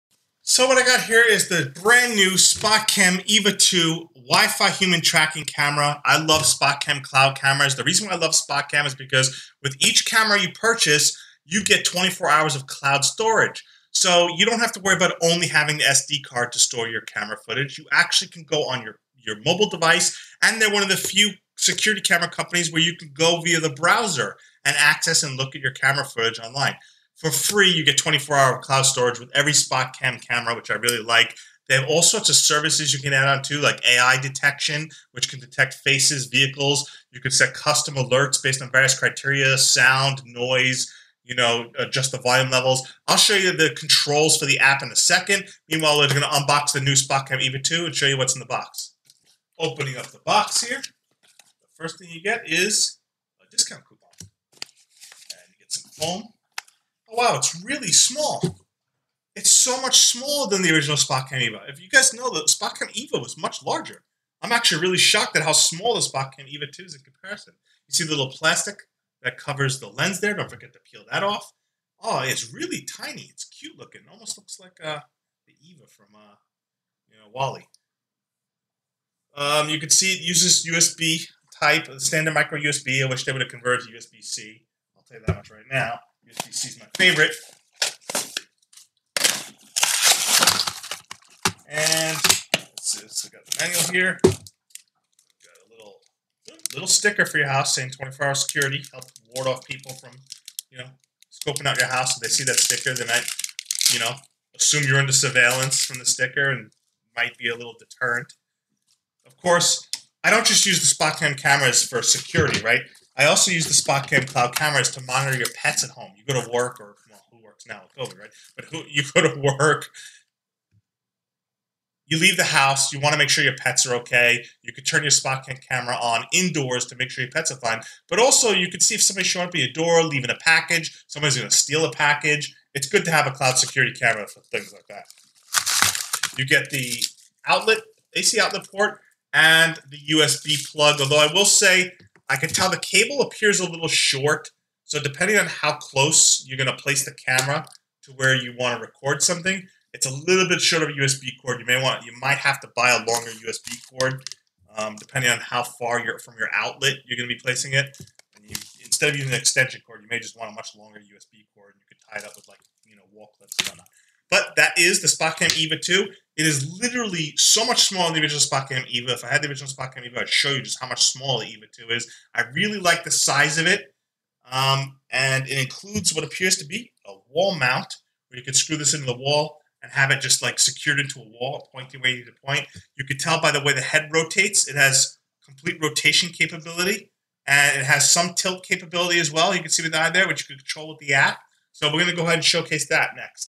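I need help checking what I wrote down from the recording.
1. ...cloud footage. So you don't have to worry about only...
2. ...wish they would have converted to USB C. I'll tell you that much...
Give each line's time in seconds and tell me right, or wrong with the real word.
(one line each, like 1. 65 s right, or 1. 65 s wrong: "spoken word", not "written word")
1. 12 s wrong: "storage", not "footage"
2. 83 s right.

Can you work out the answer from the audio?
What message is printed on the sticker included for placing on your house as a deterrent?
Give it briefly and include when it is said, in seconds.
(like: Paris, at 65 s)
24-hour security, at 97 s.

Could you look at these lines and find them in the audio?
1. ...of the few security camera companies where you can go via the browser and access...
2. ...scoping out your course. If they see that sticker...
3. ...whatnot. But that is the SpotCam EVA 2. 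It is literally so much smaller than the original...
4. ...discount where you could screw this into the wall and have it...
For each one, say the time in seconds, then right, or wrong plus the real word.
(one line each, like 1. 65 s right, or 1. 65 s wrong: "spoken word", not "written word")
1. 20 s right
2. 101 s wrong: "house", not "course"
3. 163 s right
4. 177 s wrong: "mount", not "discount".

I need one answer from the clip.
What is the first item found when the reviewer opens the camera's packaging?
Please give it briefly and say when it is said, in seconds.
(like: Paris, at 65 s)
Discount coupon, at 53 s.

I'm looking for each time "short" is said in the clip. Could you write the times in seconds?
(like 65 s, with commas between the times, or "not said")
143 s, 150 s.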